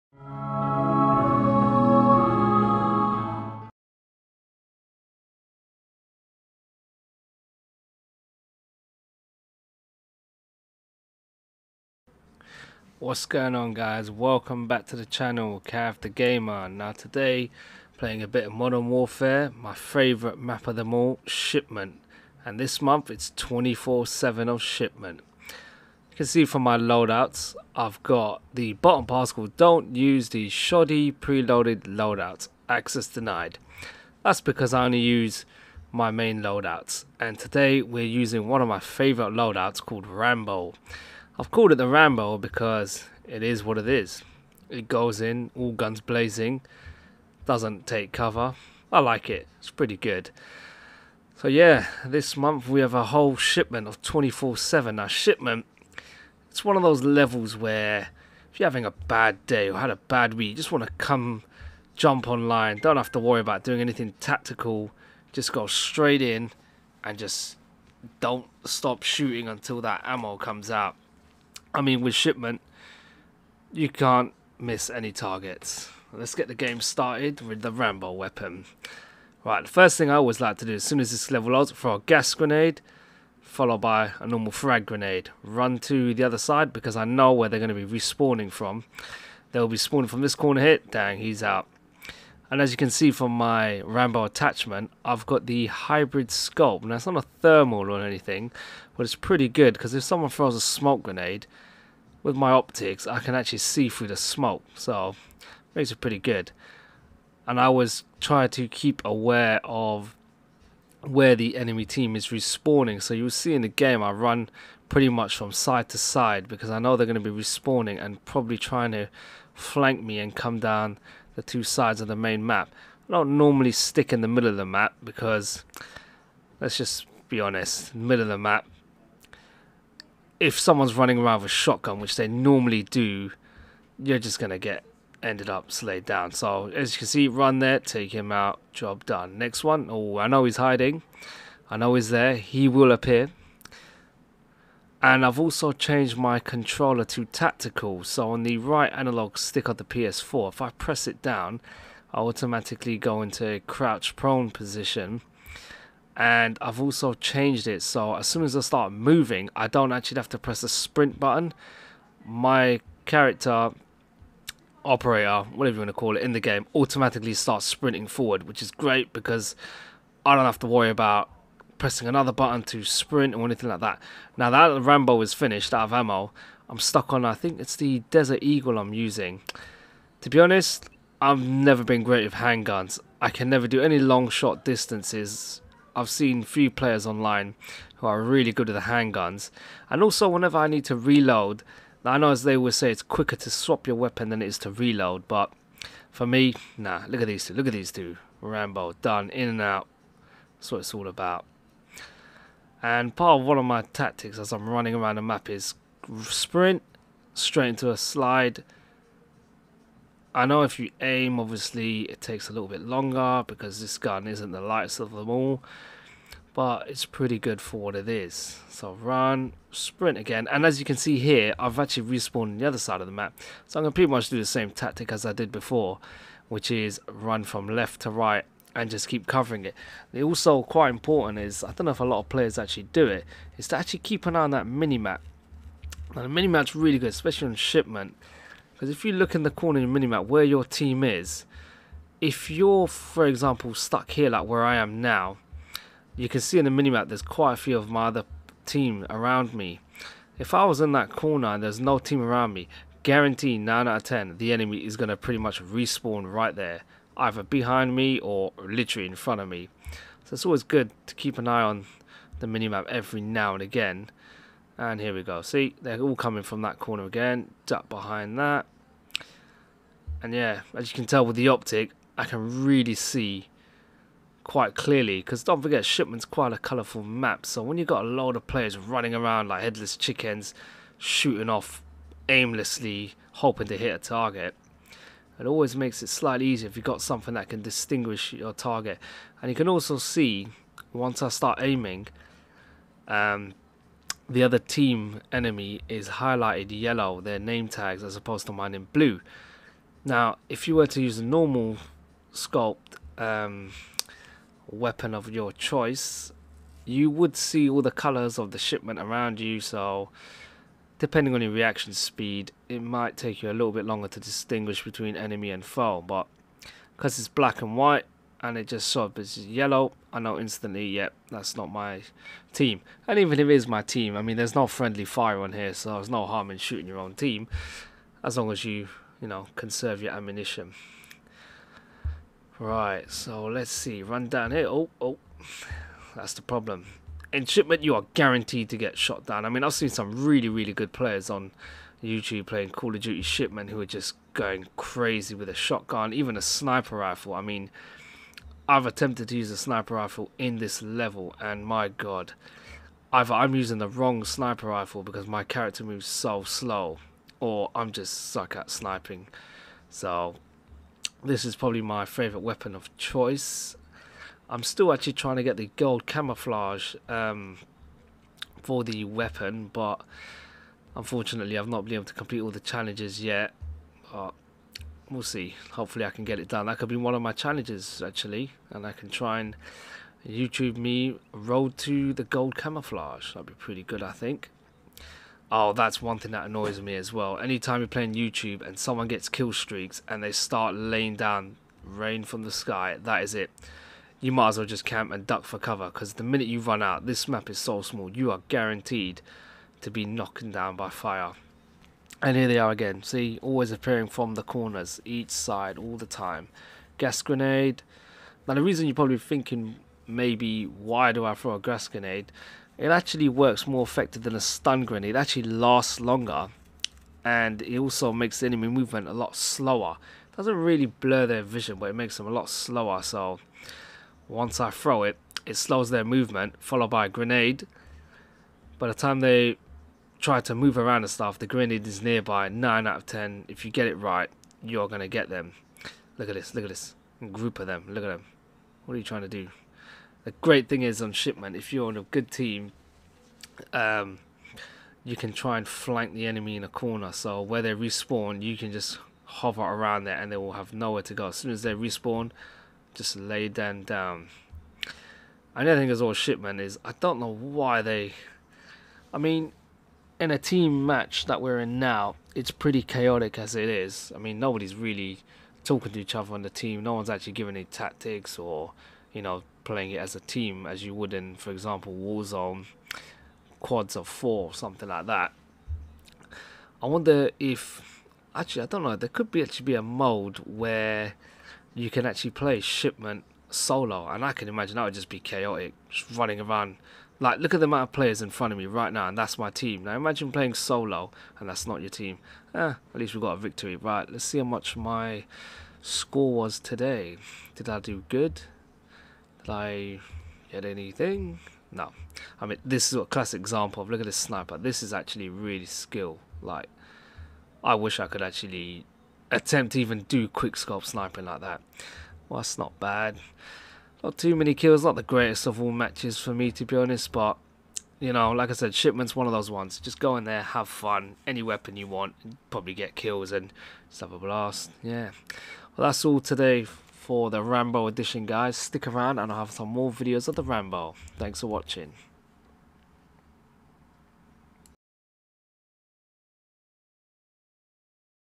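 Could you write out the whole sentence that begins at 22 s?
And this month it's 24-7 of Shipment.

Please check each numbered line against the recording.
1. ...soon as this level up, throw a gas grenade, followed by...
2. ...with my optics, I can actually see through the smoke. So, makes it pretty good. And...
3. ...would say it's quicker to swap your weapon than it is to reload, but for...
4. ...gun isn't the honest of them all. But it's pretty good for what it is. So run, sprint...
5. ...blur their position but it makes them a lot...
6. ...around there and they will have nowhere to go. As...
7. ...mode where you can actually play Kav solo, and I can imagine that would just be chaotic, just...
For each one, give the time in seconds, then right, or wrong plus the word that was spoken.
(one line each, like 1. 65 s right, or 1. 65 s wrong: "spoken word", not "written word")
1. 80 s right
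2. 102 s right
3. 192 s right
4. 213 s wrong: "lightest", not "honest"
5. 420 s wrong: "vision", not "position"
6. 449 s right
7. 479 s wrong: "Shipment", not "Kav".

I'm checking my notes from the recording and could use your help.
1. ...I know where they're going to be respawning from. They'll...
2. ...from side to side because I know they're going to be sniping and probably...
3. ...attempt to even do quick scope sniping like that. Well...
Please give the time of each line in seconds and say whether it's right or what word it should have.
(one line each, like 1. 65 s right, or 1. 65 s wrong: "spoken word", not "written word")
1. 86 s right
2. 115 s wrong: "respawning", not "sniping"
3. 509 s right.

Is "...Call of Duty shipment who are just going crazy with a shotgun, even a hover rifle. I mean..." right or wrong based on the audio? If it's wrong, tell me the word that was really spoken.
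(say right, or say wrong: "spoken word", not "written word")
wrong: "sniper", not "hover".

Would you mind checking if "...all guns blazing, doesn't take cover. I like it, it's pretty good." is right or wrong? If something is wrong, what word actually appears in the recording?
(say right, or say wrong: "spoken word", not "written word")
right.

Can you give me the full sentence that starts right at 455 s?
Another thing is all shit, man, is I don't know why they.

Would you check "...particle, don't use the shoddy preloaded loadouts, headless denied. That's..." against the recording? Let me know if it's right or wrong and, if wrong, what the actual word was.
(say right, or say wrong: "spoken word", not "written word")
wrong: "access", not "headless".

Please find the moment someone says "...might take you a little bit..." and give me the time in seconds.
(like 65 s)
312 s.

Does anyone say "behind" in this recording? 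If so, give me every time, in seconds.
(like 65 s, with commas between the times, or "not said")
257 s, 267 s.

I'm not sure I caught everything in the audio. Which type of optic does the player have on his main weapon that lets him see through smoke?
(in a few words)
hybrid sculpt.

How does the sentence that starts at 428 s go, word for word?
By the time they try to move around and stuff, the grenade is nearby.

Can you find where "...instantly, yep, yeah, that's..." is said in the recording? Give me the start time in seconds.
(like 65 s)
320 s.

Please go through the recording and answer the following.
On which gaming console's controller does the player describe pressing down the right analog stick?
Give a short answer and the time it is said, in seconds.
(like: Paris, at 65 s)
PS4, at 149 s.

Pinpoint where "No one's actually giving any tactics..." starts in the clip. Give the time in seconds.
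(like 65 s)
466 s.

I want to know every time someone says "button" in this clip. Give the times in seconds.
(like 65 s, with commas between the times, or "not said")
161 s, 172 s.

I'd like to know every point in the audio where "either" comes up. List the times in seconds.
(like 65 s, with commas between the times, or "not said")
257 s, 353 s.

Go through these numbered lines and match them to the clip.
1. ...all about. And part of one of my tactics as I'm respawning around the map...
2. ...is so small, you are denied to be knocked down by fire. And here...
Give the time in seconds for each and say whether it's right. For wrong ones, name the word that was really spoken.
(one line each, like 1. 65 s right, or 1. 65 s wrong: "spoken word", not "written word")
1. 200 s wrong: "running", not "respawning"
2. 397 s wrong: "guaranteed", not "denied".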